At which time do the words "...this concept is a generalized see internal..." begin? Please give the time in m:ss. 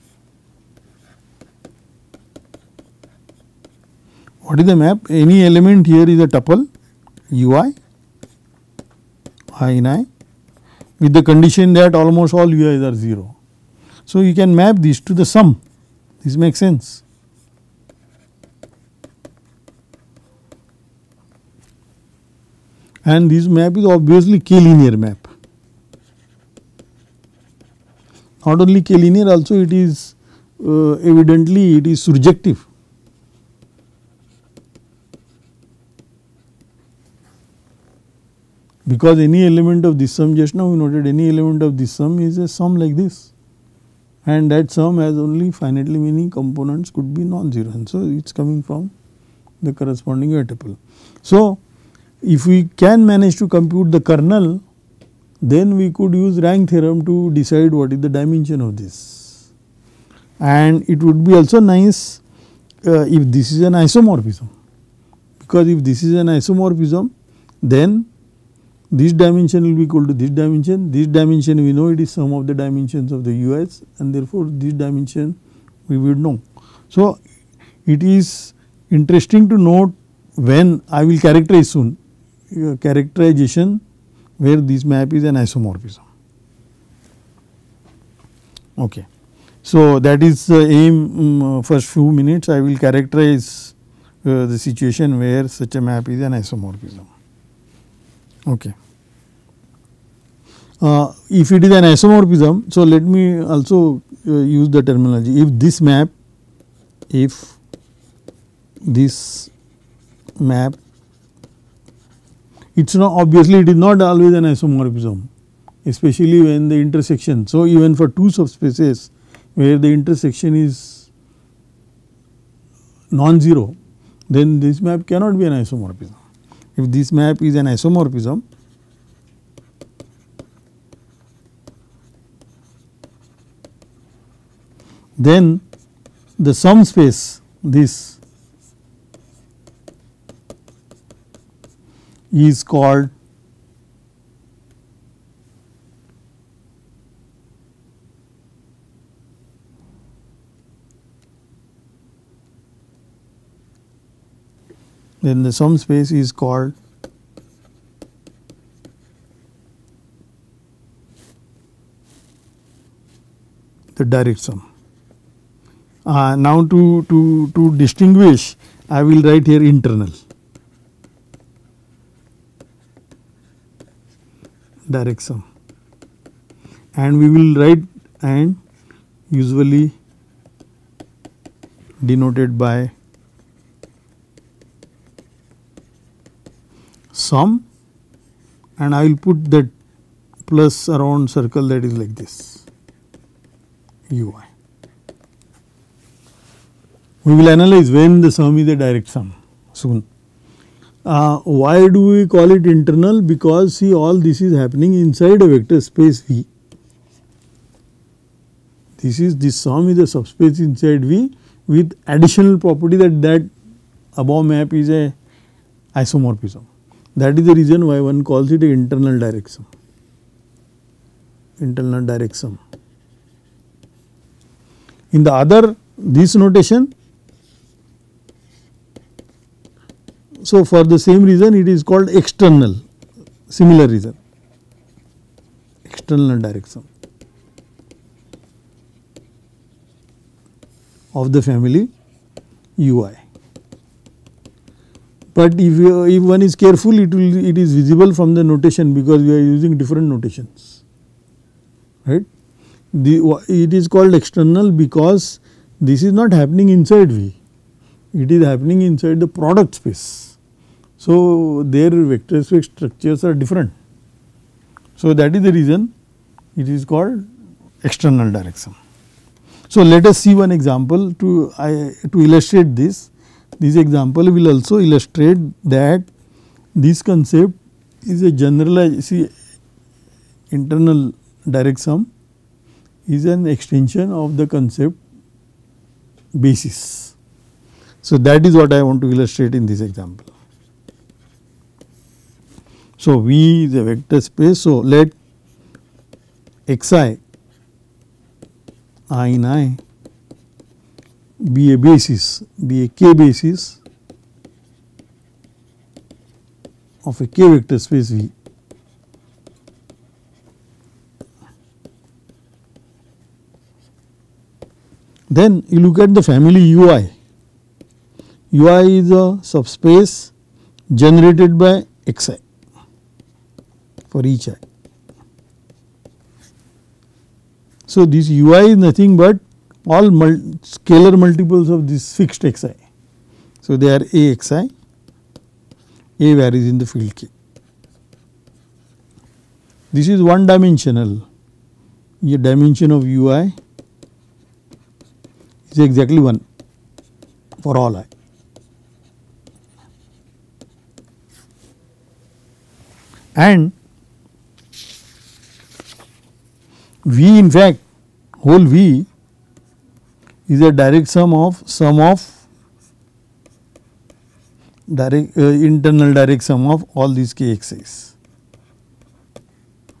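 4:36.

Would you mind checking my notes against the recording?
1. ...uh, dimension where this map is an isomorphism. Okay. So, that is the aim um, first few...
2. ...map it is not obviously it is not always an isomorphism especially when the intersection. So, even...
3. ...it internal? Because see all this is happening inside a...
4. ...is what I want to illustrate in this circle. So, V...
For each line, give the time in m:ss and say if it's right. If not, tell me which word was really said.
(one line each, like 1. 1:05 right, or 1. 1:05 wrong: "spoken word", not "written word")
1. 1:22 wrong: "characterization", not "dimension"
2. 1:50 right
3. 3:22 right
4. 4:48 wrong: "example", not "circle".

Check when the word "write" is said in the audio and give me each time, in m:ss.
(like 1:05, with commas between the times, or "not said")
2:49, 2:57.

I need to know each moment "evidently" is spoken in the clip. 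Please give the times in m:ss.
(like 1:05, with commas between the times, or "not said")
0:31.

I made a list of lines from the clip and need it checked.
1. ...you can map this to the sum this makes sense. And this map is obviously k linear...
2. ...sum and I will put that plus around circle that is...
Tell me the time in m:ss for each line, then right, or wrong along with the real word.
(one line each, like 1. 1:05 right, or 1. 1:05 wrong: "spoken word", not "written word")
1. 0:14 right
2. 3:07 right.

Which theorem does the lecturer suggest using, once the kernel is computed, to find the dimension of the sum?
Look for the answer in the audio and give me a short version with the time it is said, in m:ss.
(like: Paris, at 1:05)
rank theorem, at 0:56.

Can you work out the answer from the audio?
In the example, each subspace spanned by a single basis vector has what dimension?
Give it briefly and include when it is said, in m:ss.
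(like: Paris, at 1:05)
1, at 5:45.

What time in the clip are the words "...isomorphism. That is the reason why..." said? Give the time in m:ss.
3:35.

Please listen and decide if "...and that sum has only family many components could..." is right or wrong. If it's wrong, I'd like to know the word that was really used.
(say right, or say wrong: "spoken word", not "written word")
wrong: "finitely", not "family".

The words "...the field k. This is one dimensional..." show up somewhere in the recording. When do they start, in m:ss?
5:36.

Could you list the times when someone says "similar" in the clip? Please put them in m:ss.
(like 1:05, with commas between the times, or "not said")
3:53.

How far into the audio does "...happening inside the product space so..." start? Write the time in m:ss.
4:18.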